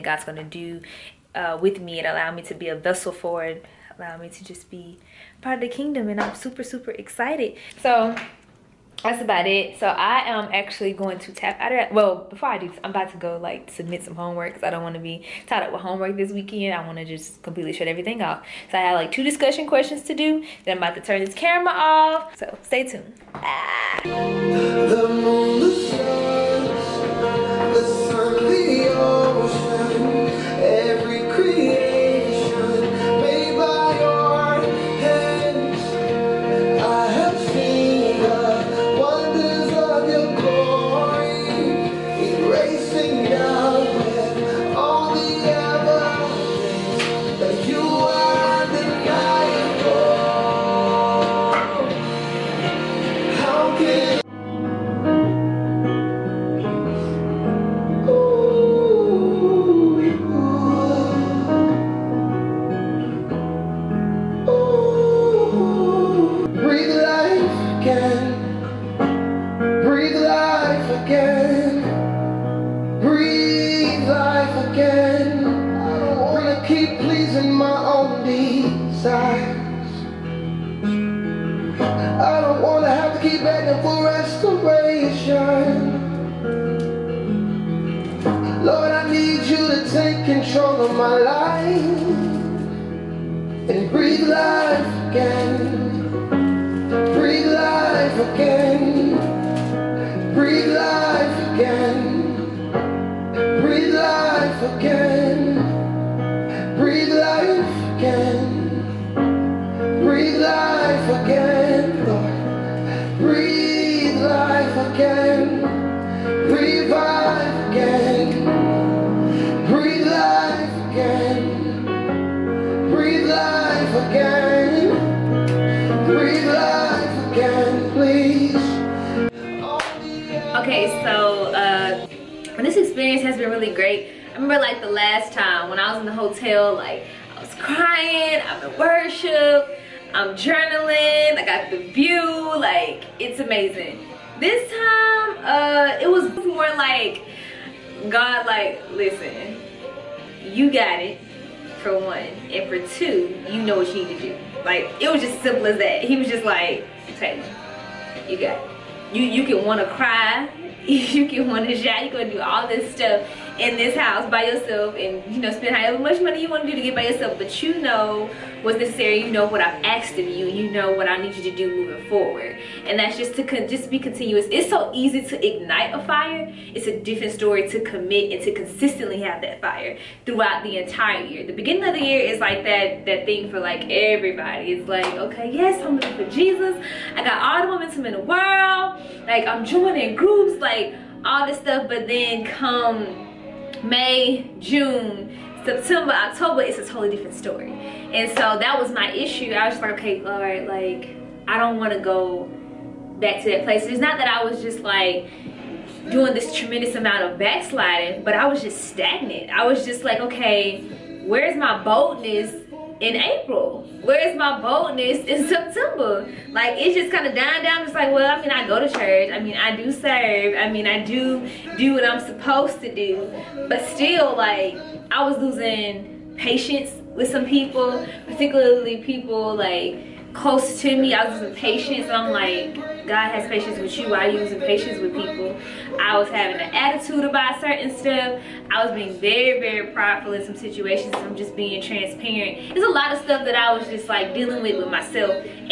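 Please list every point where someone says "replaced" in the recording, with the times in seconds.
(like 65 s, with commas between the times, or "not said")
not said.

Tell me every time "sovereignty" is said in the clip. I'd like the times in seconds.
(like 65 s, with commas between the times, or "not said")
not said.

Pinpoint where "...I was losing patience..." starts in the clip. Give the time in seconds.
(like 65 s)
225 s.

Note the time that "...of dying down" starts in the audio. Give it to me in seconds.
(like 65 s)
217 s.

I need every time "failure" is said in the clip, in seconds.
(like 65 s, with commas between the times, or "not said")
not said.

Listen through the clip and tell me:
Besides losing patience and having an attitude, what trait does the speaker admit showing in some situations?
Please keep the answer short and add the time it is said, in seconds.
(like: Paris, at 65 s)
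Prideful, at 239 s.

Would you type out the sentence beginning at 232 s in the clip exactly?
I'm like, God has patience with you.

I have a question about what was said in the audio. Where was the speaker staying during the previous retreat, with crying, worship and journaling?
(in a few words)
The hotel.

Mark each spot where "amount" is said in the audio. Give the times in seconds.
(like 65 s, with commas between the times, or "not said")
206 s.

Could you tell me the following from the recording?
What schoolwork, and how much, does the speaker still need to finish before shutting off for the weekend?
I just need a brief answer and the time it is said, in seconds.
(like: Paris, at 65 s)
2 discussion questions, at 19 s.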